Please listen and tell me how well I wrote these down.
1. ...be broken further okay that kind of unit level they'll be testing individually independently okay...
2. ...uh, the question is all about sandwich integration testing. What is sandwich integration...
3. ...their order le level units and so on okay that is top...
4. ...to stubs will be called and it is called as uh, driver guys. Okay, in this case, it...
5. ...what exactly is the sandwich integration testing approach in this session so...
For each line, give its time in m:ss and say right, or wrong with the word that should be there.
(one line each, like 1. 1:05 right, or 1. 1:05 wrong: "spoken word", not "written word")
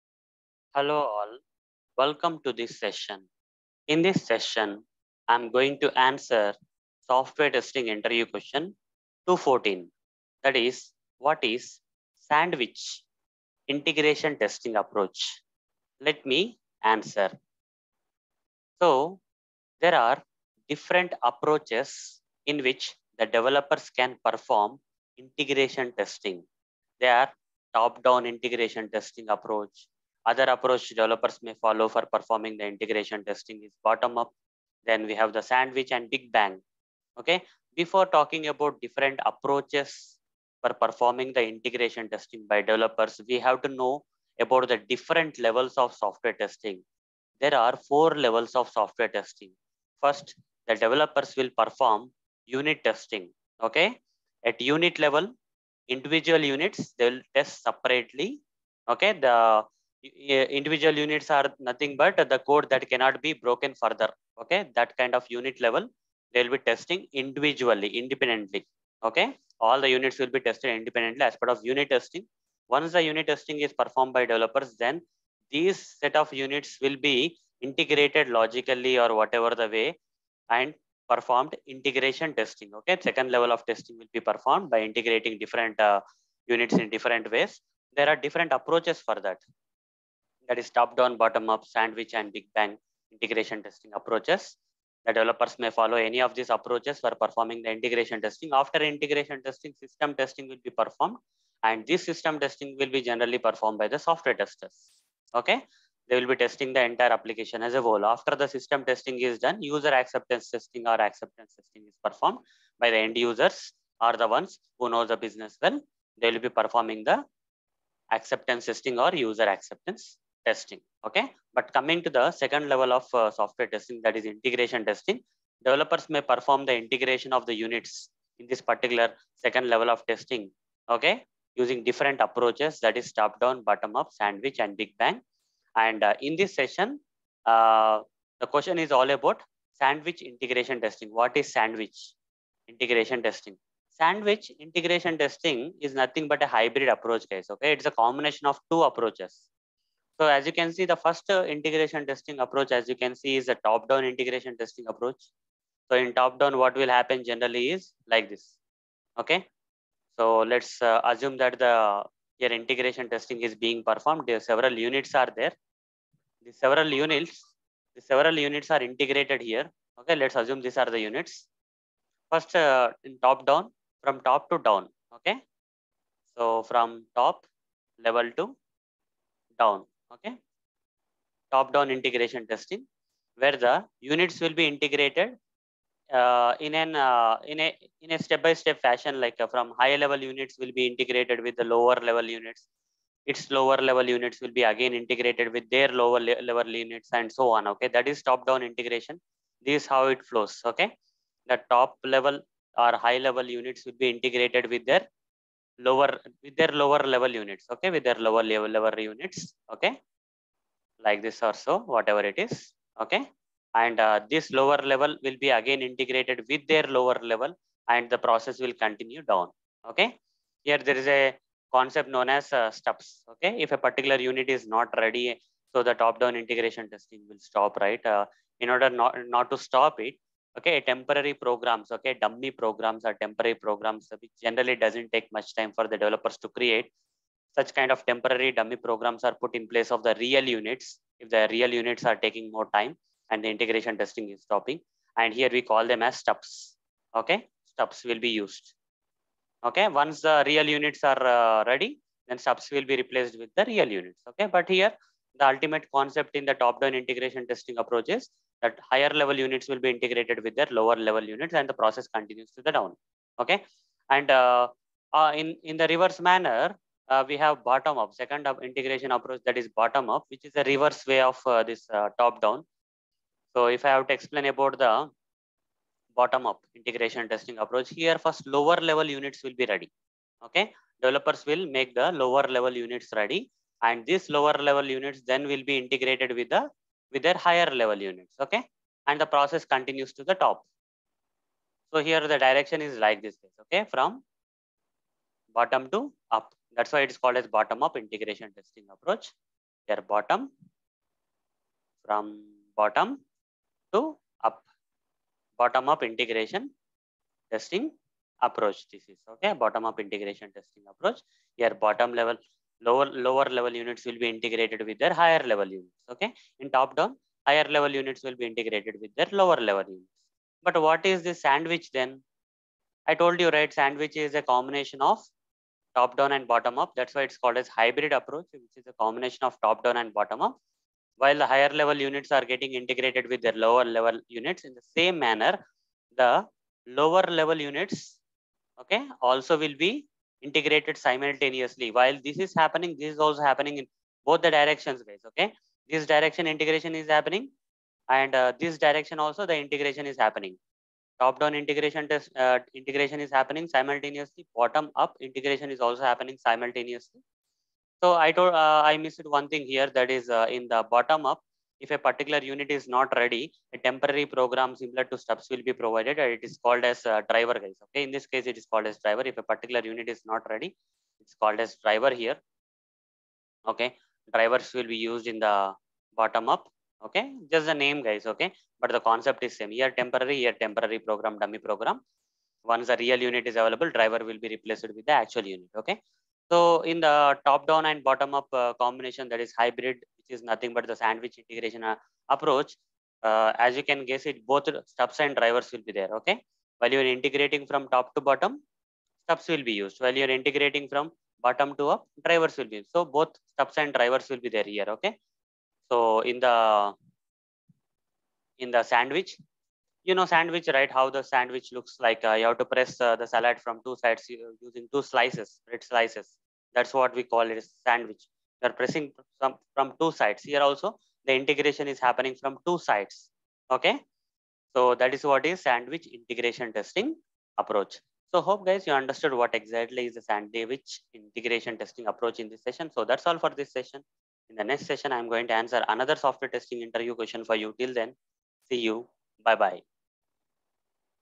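1. 1:03 right
2. 2:17 right
3. 3:15 wrong: "lower", not "order"
4. 6:05 wrong: "provided", not "called"
5. 7:09 right.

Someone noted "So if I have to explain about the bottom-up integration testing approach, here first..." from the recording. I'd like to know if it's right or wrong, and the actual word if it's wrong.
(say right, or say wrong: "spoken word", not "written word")
right.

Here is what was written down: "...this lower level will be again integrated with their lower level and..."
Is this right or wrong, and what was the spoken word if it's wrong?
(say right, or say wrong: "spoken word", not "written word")
right.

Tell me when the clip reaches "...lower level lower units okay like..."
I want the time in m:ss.
3:28.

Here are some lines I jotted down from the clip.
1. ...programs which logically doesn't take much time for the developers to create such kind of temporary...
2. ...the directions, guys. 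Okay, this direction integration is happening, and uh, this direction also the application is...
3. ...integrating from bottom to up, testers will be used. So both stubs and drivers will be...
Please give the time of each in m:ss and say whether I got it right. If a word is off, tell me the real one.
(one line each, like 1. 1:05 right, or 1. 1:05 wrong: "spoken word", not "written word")
1. 3:53 wrong: "generally", not "logically"
2. 5:44 wrong: "integration", not "application"
3. 6:40 wrong: "drivers", not "testers".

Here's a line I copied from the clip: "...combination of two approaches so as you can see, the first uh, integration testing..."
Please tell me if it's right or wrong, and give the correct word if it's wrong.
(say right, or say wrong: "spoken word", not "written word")
right.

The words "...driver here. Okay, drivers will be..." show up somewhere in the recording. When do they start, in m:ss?
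6:11.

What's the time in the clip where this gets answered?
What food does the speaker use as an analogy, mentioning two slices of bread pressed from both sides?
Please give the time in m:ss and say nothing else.
6:53.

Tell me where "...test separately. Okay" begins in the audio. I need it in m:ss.
0:57.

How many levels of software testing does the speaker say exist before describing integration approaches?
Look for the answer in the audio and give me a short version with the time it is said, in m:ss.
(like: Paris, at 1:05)
4, at 0:47.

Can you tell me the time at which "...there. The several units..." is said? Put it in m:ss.
2:45.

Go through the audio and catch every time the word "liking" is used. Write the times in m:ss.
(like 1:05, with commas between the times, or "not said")
not said.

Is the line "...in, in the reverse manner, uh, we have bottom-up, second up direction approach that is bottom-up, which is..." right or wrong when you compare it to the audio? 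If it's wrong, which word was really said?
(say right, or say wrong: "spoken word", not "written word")
wrong: "integration", not "direction".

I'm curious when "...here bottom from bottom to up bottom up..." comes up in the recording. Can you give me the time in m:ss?
4:59.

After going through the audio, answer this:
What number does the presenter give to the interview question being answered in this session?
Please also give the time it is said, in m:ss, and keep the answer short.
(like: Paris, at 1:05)
214, at 0:09.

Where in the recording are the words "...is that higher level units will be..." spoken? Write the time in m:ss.
4:18.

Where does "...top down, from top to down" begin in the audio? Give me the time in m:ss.
2:53.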